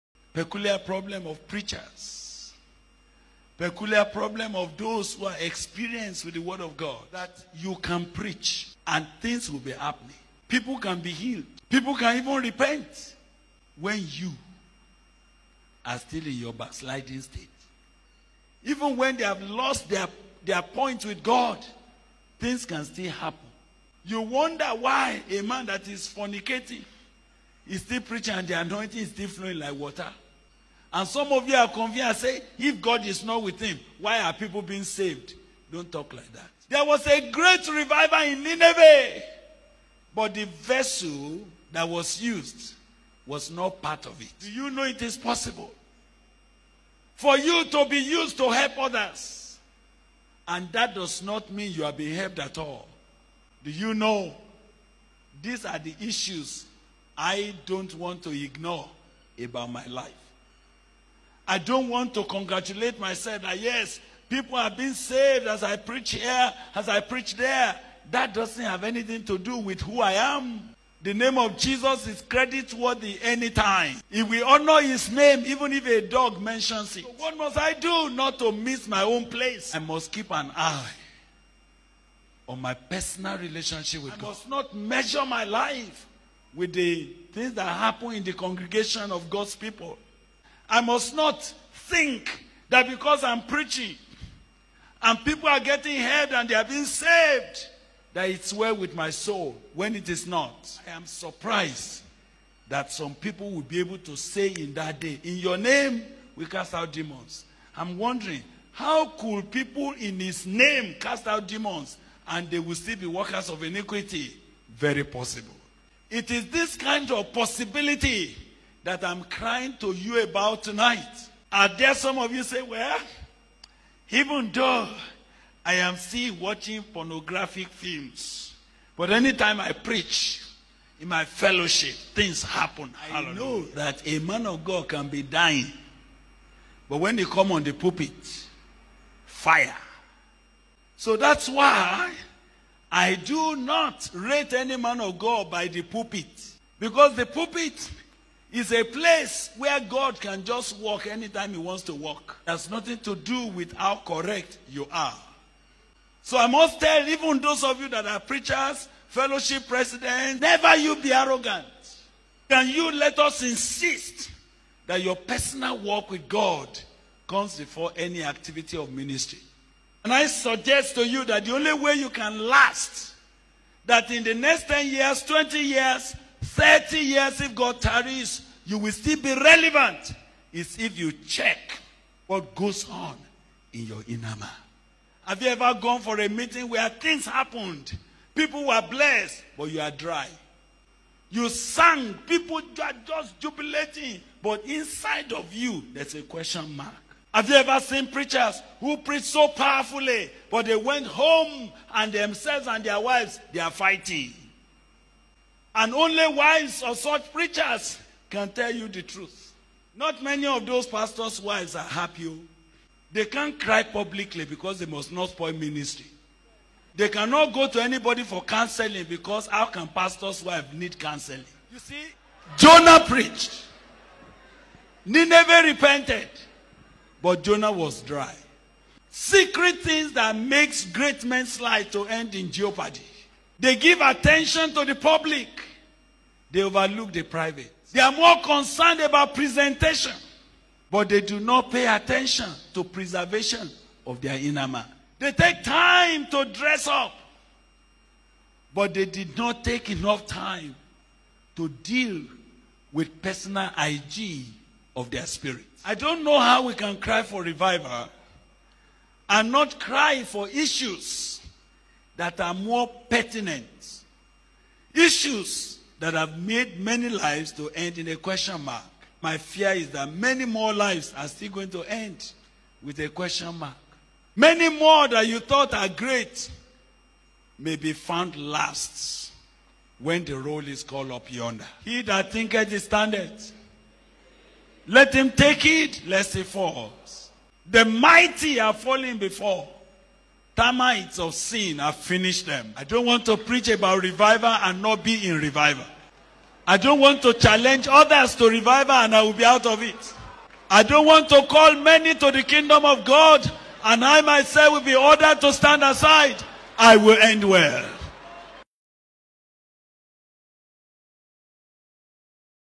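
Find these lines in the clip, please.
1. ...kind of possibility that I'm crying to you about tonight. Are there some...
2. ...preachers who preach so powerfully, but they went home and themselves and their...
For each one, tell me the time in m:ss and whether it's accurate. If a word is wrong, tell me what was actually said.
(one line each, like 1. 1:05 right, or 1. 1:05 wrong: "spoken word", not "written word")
1. 1:56 right
2. 3:18 right.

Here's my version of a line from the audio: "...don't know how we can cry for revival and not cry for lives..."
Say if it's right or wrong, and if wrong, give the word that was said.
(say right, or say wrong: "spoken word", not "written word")
wrong: "issues", not "lives".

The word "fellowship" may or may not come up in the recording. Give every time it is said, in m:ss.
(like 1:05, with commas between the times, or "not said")
2:11, 2:39.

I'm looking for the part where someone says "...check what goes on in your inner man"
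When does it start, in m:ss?
3:01.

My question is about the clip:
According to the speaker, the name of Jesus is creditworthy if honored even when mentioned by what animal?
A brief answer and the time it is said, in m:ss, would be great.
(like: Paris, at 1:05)
a dog, at 1:15.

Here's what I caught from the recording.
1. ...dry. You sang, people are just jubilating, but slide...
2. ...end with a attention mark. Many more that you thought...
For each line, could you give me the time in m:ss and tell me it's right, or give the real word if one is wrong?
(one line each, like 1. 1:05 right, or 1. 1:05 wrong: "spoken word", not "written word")
1. 3:09 wrong: "inside", not "slide"
2. 4:31 wrong: "question", not "attention".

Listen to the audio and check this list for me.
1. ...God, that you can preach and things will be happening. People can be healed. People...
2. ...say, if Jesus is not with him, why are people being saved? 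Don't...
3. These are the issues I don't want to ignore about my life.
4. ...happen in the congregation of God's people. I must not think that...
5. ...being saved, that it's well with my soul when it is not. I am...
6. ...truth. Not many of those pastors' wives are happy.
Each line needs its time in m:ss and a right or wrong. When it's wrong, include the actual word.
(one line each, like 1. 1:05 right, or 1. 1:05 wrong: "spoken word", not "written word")
1. 0:06 right
2. 0:32 wrong: "God", not "Jesus"
3. 0:55 right
4. 1:27 right
5. 1:36 right
6. 3:29 right.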